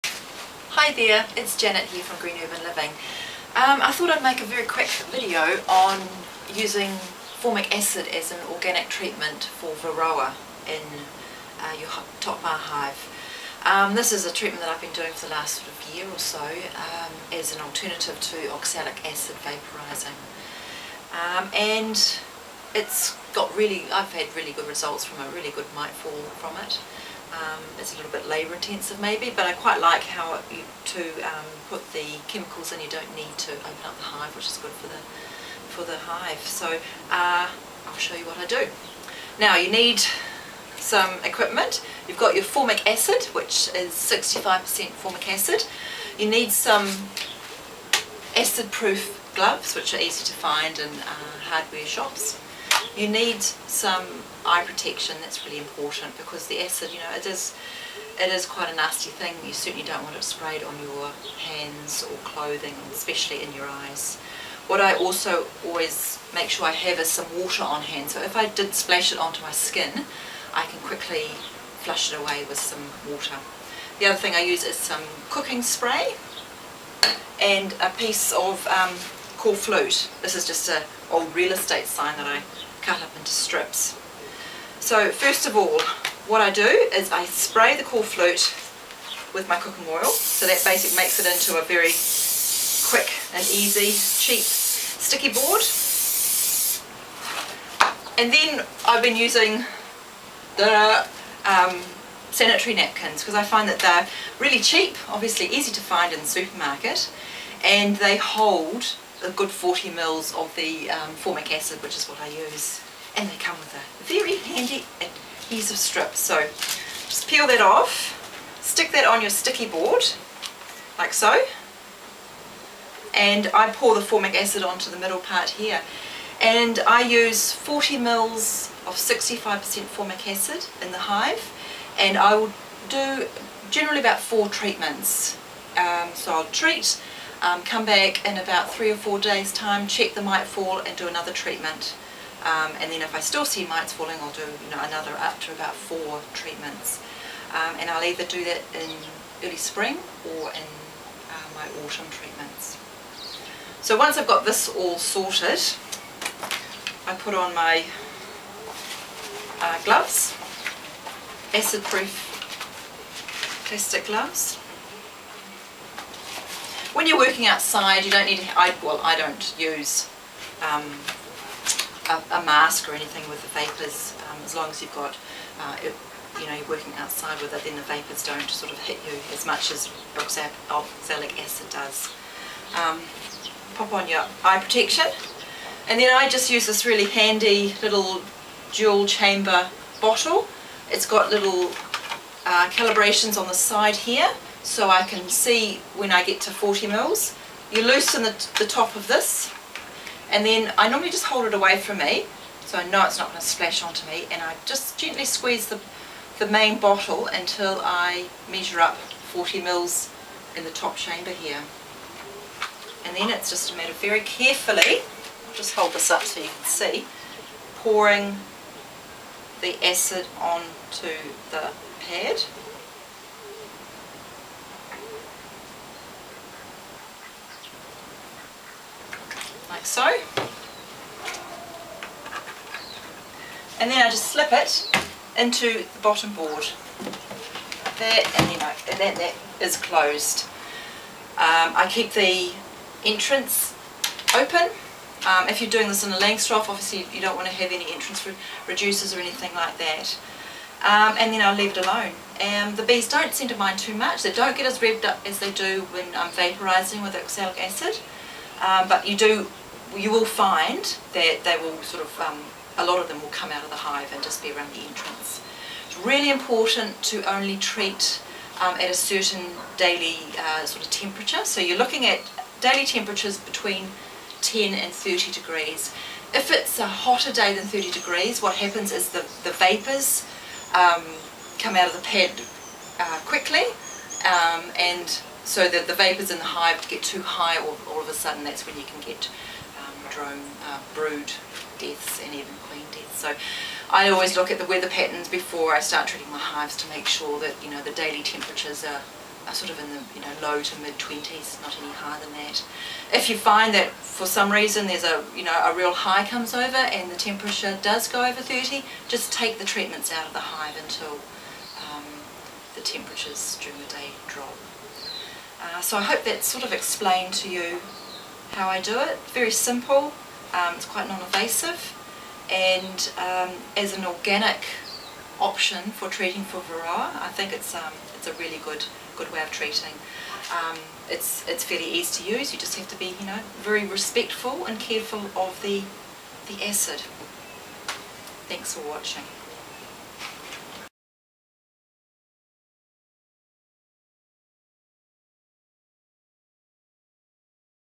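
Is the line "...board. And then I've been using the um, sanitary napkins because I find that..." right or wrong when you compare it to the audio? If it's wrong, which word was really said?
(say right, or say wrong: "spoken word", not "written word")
right.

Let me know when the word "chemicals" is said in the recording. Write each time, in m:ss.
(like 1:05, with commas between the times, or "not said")
0:32.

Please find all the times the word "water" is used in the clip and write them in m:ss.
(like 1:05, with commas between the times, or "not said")
1:07, 1:13.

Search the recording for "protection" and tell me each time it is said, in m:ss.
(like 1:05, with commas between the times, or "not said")
0:54, 3:04.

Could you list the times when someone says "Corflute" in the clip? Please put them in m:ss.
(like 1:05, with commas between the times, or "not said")
1:19, 1:27.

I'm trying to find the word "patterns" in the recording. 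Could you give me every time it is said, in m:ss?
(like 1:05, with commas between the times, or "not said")
4:54.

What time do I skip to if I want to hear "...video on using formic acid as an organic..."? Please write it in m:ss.
0:05.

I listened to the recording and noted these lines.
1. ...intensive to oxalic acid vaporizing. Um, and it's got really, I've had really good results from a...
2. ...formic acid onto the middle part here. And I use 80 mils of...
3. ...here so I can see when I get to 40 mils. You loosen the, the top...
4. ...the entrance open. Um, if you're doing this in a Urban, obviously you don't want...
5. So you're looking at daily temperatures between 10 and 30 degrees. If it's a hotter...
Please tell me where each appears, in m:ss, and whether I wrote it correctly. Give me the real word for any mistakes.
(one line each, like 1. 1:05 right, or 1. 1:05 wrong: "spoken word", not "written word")
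1. 0:17 wrong: "alternative", not "intensive"
2. 2:04 wrong: "40", not "80"
3. 3:13 right
4. 4:02 wrong: "Langstroth", not "Urban"
5. 4:31 right.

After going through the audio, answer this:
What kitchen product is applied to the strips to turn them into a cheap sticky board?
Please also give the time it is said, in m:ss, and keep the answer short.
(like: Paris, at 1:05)
Cooking spray, at 1:15.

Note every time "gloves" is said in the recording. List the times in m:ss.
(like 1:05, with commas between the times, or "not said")
0:49, 2:39, 2:44.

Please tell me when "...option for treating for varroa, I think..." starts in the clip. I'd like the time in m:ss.
5:25.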